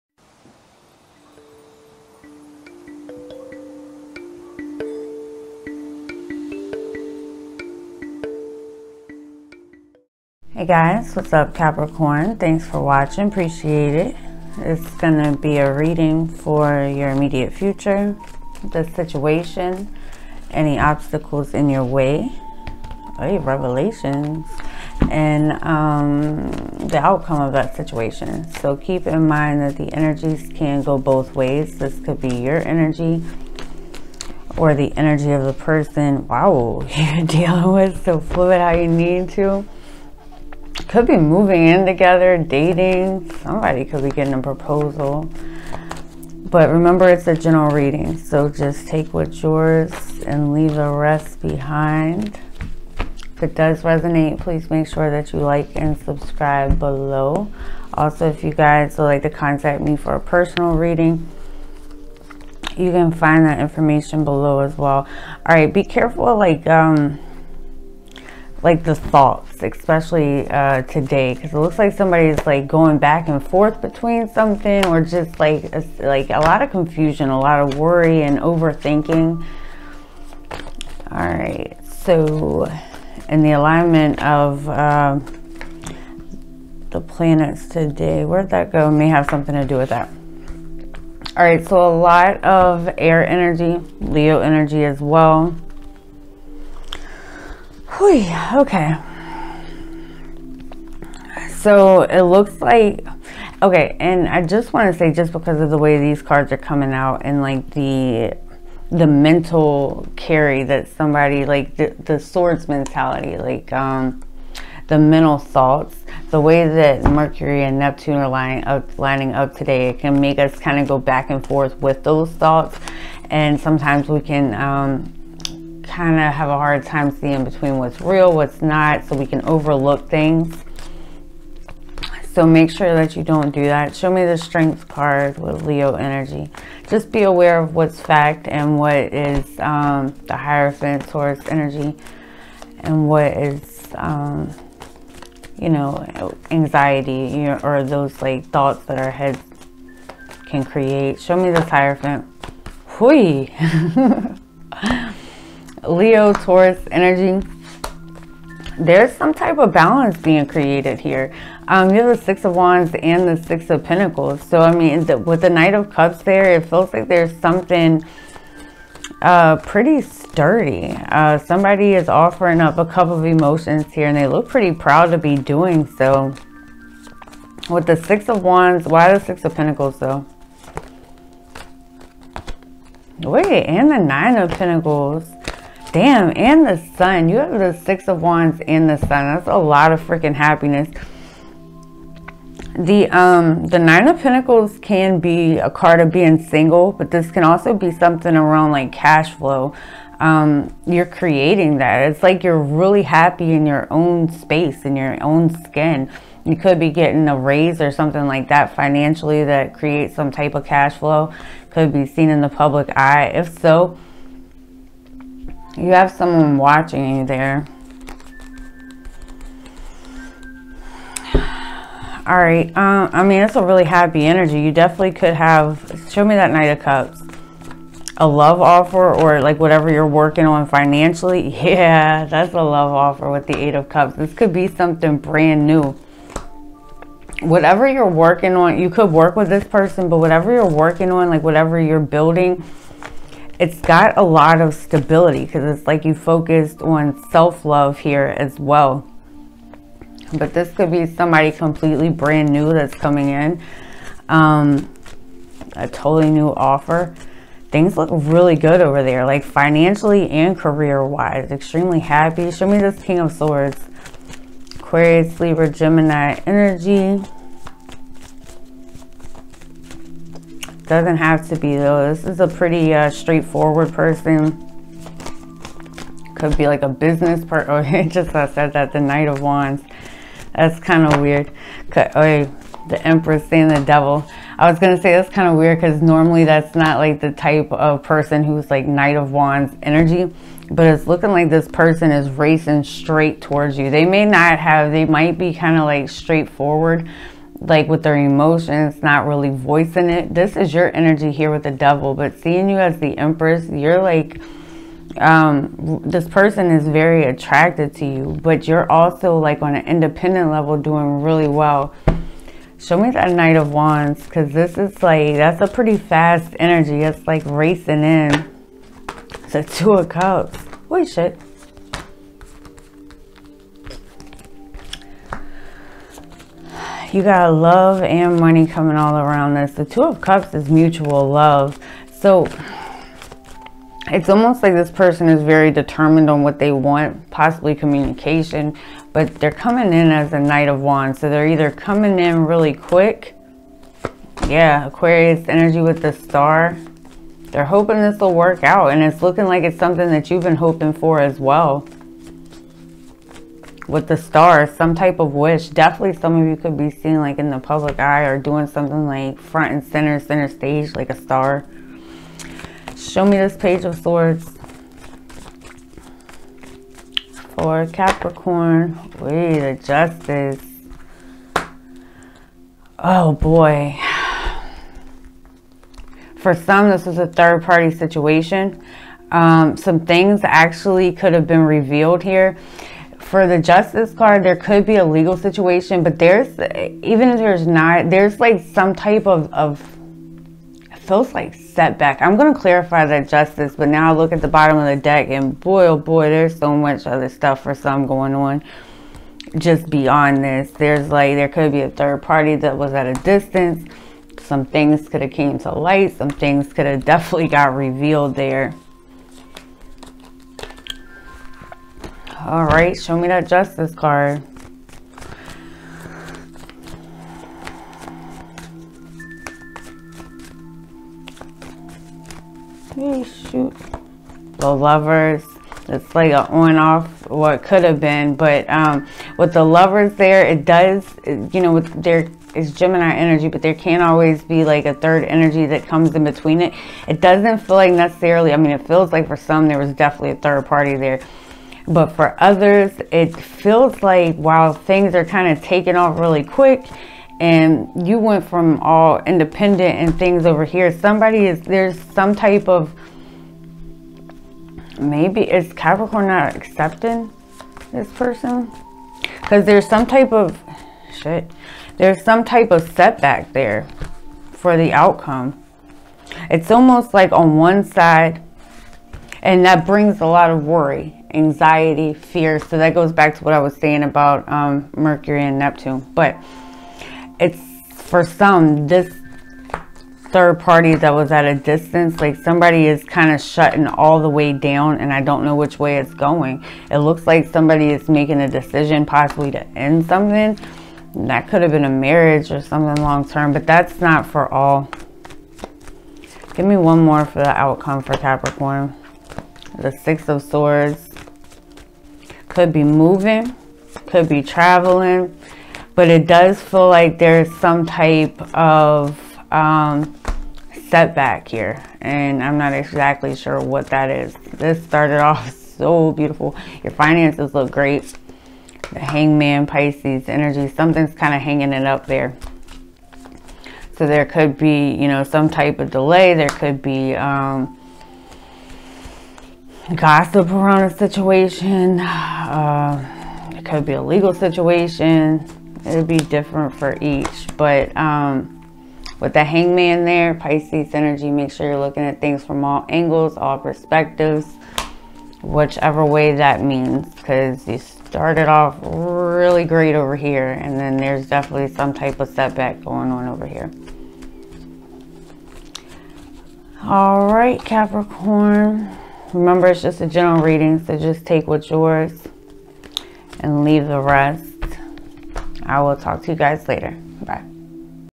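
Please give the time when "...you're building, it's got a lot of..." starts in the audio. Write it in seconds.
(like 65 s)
241 s.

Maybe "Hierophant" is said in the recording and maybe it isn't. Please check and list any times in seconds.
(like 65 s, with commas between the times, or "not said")
140 s, 151 s.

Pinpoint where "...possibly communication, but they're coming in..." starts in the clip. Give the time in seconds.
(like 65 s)
337 s.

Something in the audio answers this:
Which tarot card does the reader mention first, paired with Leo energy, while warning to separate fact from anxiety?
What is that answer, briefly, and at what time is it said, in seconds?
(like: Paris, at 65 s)
Strength, at 134 s.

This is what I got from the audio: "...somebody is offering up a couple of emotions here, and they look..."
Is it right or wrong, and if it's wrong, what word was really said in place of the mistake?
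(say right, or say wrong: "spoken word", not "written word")
right.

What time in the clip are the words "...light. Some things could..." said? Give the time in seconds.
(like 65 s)
405 s.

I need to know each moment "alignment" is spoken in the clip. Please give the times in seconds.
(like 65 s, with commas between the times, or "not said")
83 s.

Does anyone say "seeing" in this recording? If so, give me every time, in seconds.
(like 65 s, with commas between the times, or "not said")
127 s, 302 s.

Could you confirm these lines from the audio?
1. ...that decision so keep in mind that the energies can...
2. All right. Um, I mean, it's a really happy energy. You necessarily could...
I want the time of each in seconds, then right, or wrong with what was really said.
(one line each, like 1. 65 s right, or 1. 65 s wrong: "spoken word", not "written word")
1. 27 s wrong: "situation", not "decision"
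2. 221 s wrong: "definitely", not "necessarily".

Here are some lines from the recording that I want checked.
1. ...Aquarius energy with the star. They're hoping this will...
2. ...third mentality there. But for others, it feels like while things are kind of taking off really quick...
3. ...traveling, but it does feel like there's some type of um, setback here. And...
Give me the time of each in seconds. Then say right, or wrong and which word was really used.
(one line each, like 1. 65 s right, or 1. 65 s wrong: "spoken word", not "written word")
1. 344 s right
2. 440 s wrong: "party", not "mentality"
3. 504 s right.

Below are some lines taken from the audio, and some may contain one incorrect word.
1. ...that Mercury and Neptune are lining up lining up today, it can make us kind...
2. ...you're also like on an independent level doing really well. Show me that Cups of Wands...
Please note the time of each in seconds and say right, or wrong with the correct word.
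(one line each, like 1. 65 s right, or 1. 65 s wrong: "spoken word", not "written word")
1. 116 s right
2. 308 s wrong: "Knight", not "Cups".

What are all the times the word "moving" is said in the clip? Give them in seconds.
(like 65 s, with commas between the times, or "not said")
41 s, 502 s.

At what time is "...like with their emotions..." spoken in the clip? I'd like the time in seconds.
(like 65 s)
297 s.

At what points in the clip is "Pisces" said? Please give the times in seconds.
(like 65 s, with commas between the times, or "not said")
519 s, 540 s.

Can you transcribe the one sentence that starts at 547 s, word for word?
Because you started off really great over here.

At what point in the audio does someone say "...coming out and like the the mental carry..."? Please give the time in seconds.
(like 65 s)
106 s.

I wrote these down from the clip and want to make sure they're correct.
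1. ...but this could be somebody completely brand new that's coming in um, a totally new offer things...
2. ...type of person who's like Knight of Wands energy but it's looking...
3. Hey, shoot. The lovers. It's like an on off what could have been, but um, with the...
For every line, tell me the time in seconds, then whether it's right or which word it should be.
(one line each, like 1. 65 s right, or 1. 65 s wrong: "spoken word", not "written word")
1. 250 s right
2. 287 s right
3. 422 s right.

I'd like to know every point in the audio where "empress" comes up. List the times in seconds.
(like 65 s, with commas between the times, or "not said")
283 s, 303 s.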